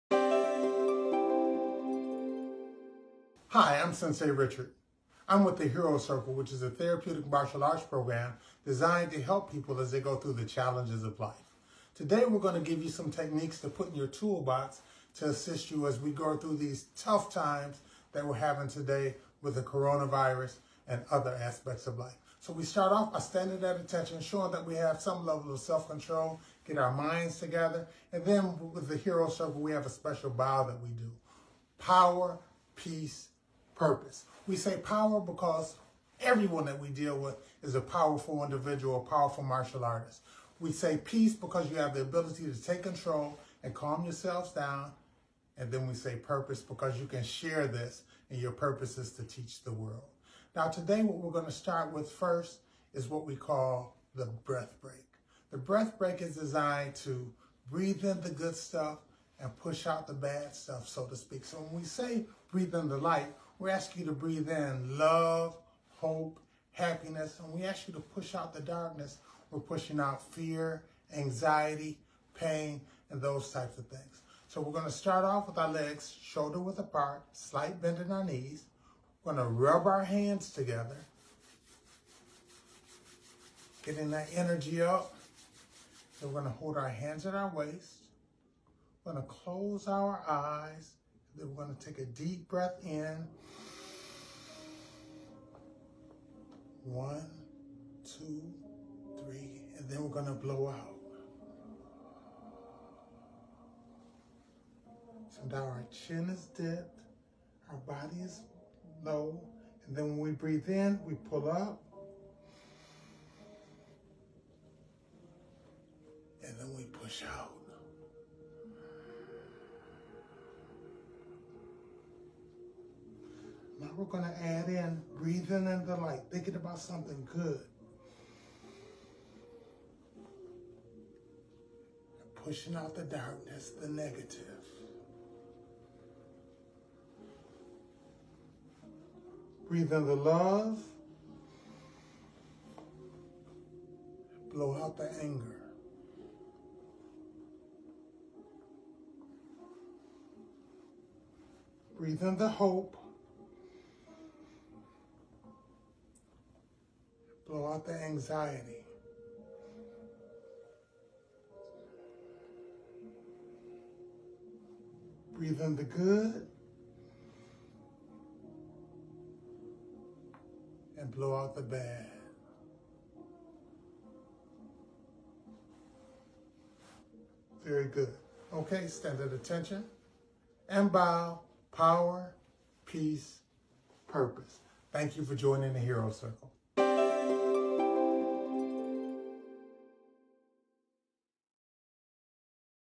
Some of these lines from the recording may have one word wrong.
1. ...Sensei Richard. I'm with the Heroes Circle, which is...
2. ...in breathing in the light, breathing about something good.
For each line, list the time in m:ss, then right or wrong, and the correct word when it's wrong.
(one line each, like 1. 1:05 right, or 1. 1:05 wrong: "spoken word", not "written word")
1. 0:03 right
2. 2:04 wrong: "thinking", not "breathing".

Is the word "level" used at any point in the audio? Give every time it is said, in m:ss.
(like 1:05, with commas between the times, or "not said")
0:25.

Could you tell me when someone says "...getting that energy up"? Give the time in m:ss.
1:23.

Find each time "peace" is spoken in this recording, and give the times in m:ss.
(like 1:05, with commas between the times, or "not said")
0:32, 0:41, 3:02.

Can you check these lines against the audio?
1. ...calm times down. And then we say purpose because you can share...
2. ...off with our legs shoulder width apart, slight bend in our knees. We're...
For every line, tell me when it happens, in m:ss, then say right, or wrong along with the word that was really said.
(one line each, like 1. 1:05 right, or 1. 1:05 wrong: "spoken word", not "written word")
1. 0:43 wrong: "yourselves", not "times"
2. 1:15 right.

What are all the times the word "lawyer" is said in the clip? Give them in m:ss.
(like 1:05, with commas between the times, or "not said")
not said.